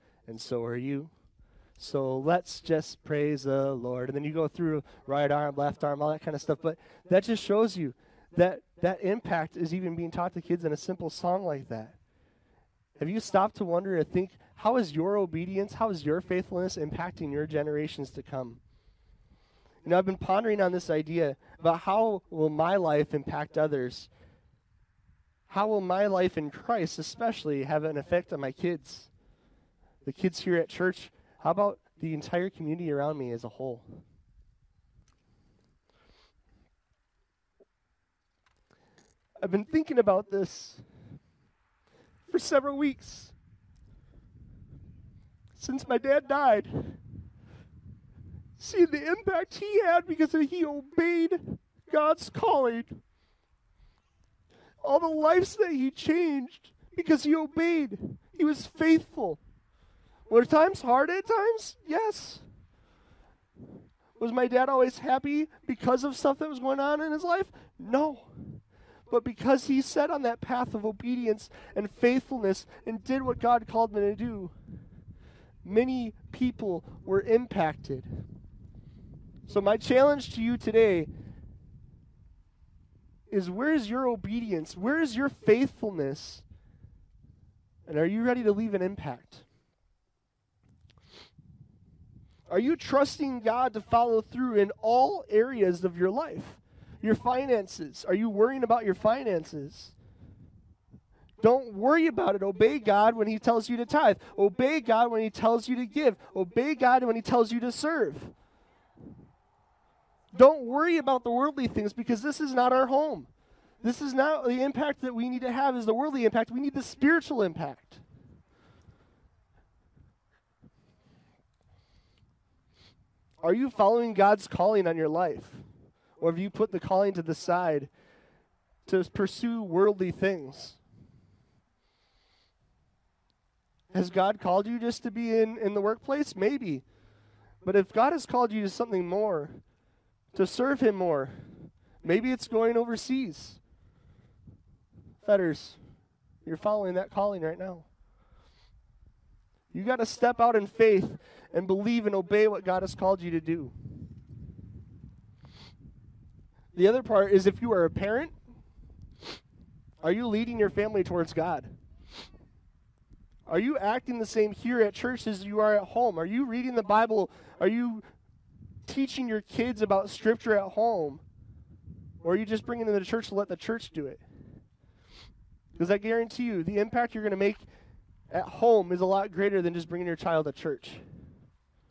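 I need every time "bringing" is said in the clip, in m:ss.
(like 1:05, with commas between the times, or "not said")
2:52, 2:59.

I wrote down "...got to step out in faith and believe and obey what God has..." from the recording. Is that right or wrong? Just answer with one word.
right.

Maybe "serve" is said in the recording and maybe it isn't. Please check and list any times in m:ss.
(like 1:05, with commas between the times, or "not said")
1:47, 2:20.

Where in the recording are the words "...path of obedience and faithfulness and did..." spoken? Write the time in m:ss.
1:10.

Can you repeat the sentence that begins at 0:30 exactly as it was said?
the kids here at church, how about the entire community around me as a whole?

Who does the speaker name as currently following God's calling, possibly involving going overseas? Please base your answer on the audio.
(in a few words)
Fetters.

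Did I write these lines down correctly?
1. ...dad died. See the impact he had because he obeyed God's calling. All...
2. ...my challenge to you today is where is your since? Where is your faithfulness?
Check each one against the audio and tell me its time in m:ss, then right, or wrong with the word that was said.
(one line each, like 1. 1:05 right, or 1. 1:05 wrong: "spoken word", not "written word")
1. 0:45 right
2. 1:19 wrong: "obedience", not "since".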